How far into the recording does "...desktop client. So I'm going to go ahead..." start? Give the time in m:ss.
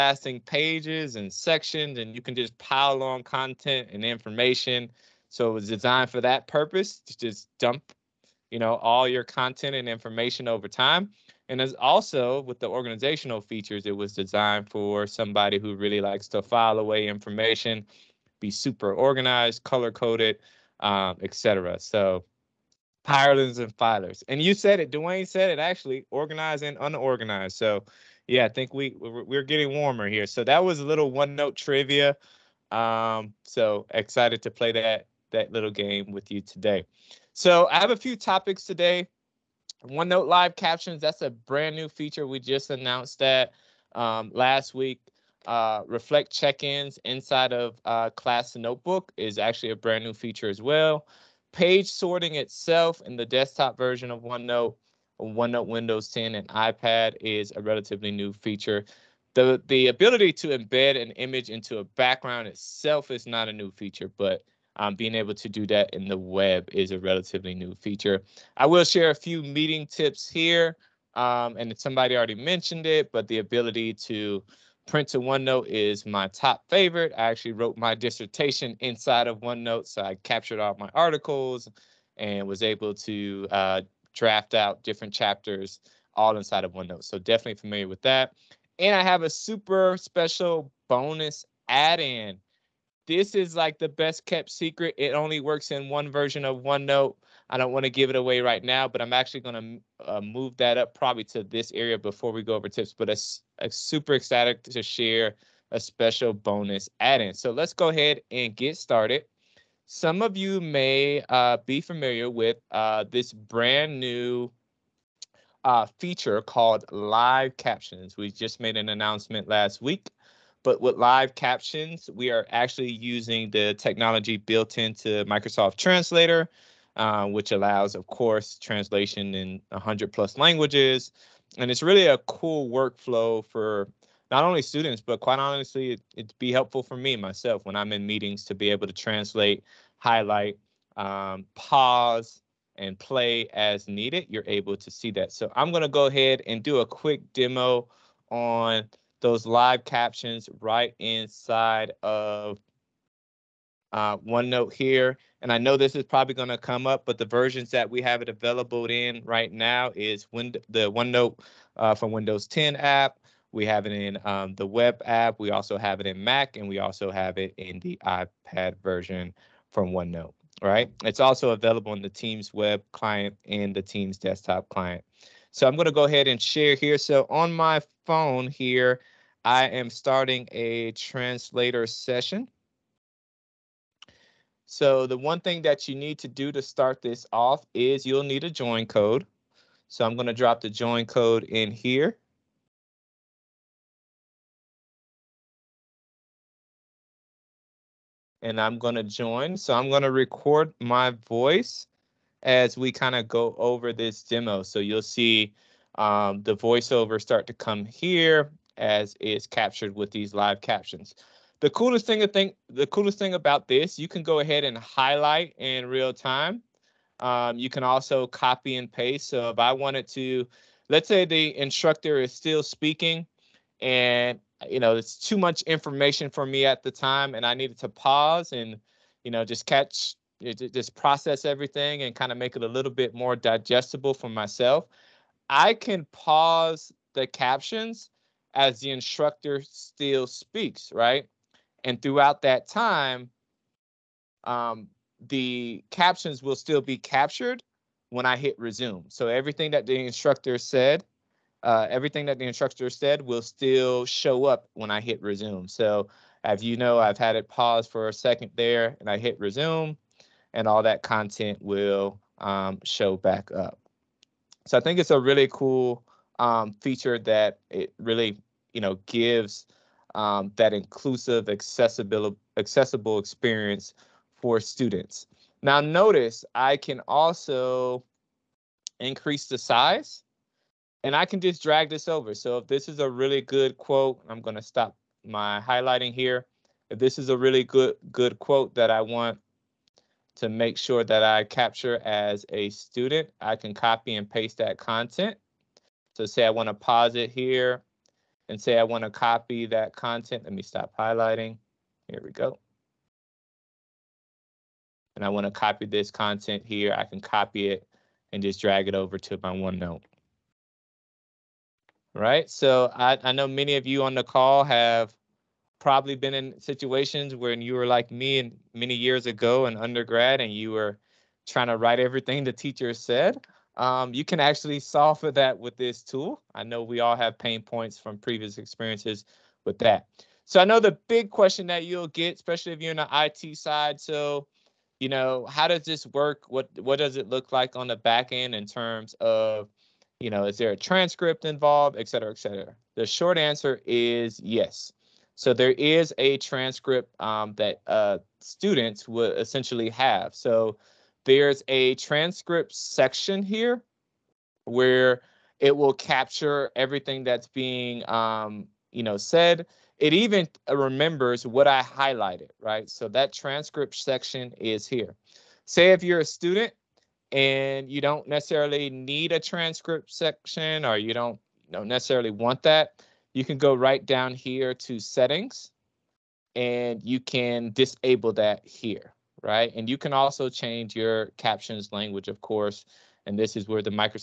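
2:54.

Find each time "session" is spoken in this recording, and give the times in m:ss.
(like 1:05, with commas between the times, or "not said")
3:01.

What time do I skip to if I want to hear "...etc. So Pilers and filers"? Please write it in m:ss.
0:21.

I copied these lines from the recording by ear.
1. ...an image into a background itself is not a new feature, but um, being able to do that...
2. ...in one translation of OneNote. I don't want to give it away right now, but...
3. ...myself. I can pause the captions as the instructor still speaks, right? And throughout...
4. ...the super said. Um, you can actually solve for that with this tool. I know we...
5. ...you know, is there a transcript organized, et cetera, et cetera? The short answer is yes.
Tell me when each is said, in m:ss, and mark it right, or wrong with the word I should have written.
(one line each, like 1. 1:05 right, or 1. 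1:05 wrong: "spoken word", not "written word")
1. 1:01 right
2. 1:35 wrong: "version", not "translation"
3. 3:54 right
4. 5:22 wrong: "teacher", not "super"
5. 5:40 wrong: "involved", not "organized".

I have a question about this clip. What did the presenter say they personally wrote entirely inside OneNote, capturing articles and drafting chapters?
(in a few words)
Dissertation.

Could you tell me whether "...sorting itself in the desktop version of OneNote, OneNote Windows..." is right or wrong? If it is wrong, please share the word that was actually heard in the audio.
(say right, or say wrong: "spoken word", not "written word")
right.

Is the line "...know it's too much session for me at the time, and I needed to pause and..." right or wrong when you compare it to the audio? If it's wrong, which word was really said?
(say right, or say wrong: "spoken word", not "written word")
wrong: "information", not "session".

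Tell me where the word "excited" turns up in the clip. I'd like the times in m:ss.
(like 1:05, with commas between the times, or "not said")
0:33, 1:44.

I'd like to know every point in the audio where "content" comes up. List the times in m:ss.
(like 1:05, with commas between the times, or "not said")
0:03, 0:09, 4:21, 4:54, 4:59, 5:06.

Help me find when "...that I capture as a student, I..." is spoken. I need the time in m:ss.
4:51.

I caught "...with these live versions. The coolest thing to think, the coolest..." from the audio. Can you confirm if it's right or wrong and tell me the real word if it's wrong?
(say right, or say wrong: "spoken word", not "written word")
wrong: "captions", not "versions".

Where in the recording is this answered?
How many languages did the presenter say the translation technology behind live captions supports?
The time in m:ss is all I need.
2:09.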